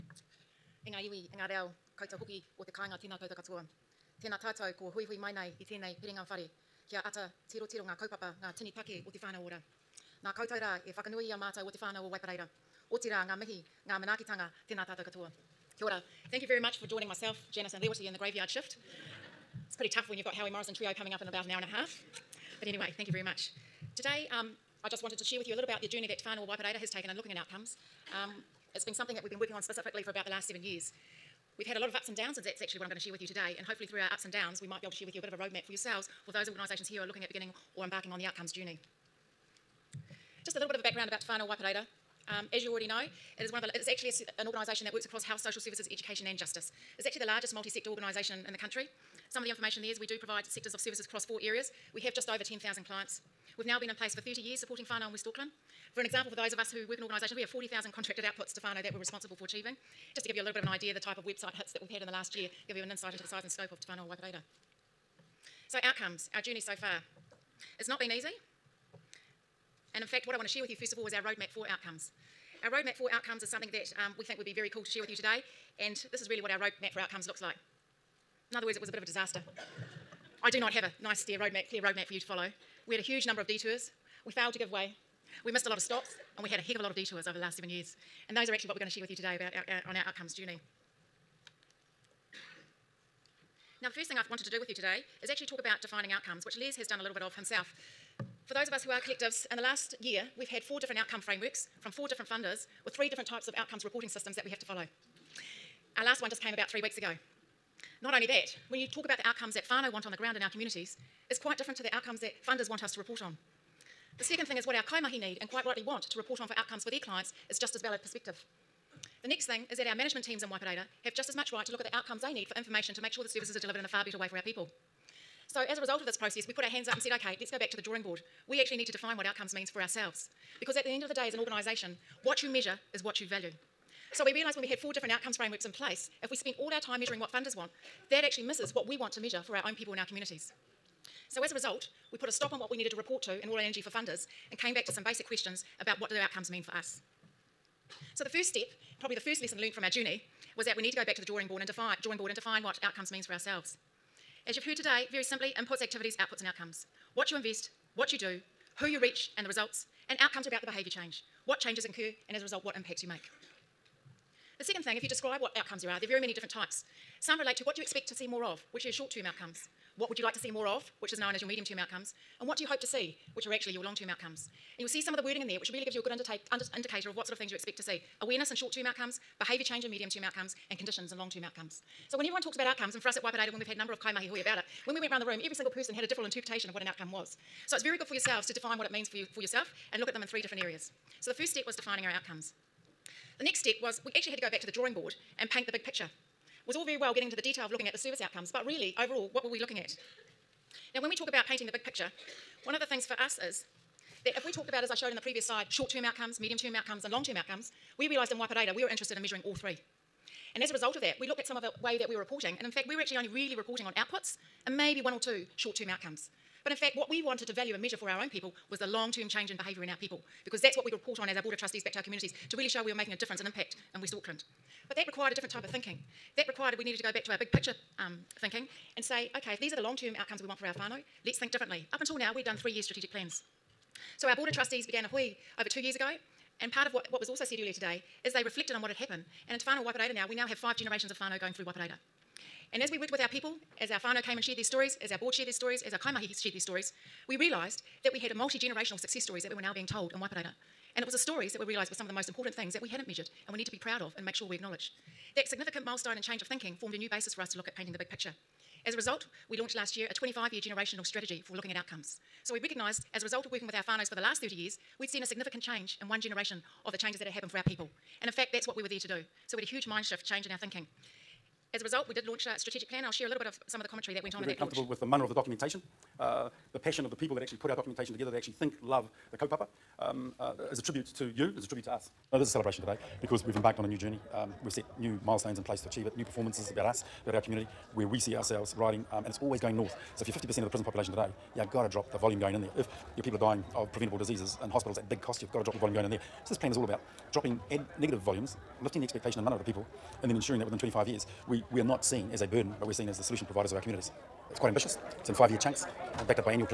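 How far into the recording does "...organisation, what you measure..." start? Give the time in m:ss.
2:11.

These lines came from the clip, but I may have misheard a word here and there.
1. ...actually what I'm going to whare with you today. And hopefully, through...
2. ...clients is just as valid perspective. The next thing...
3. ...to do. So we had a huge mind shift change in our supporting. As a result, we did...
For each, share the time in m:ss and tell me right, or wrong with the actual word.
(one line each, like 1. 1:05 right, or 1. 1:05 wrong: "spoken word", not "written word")
1. 0:32 wrong: "share", not "whare"
2. 1:56 right
3. 4:28 wrong: "thinking", not "supporting".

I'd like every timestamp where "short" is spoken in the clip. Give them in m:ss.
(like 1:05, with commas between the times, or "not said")
2:48, 2:58, 3:25, 3:35.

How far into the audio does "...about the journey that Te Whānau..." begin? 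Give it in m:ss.
0:25.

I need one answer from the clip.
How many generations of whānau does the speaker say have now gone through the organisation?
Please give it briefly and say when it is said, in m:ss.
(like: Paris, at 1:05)
5, at 4:00.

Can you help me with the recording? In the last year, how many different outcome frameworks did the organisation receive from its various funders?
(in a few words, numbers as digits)
4.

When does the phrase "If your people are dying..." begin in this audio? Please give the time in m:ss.
4:52.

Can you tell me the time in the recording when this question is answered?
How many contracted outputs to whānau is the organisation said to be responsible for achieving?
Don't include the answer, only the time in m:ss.
0:57.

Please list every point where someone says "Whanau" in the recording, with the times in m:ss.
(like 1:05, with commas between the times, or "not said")
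1:03, 3:59.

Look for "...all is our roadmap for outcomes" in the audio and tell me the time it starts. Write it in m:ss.
1:10.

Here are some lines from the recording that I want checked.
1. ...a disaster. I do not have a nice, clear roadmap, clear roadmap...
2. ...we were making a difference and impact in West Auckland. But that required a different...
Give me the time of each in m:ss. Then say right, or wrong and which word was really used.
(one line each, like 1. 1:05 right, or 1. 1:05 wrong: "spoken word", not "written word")
1. 1:19 right
2. 3:42 right.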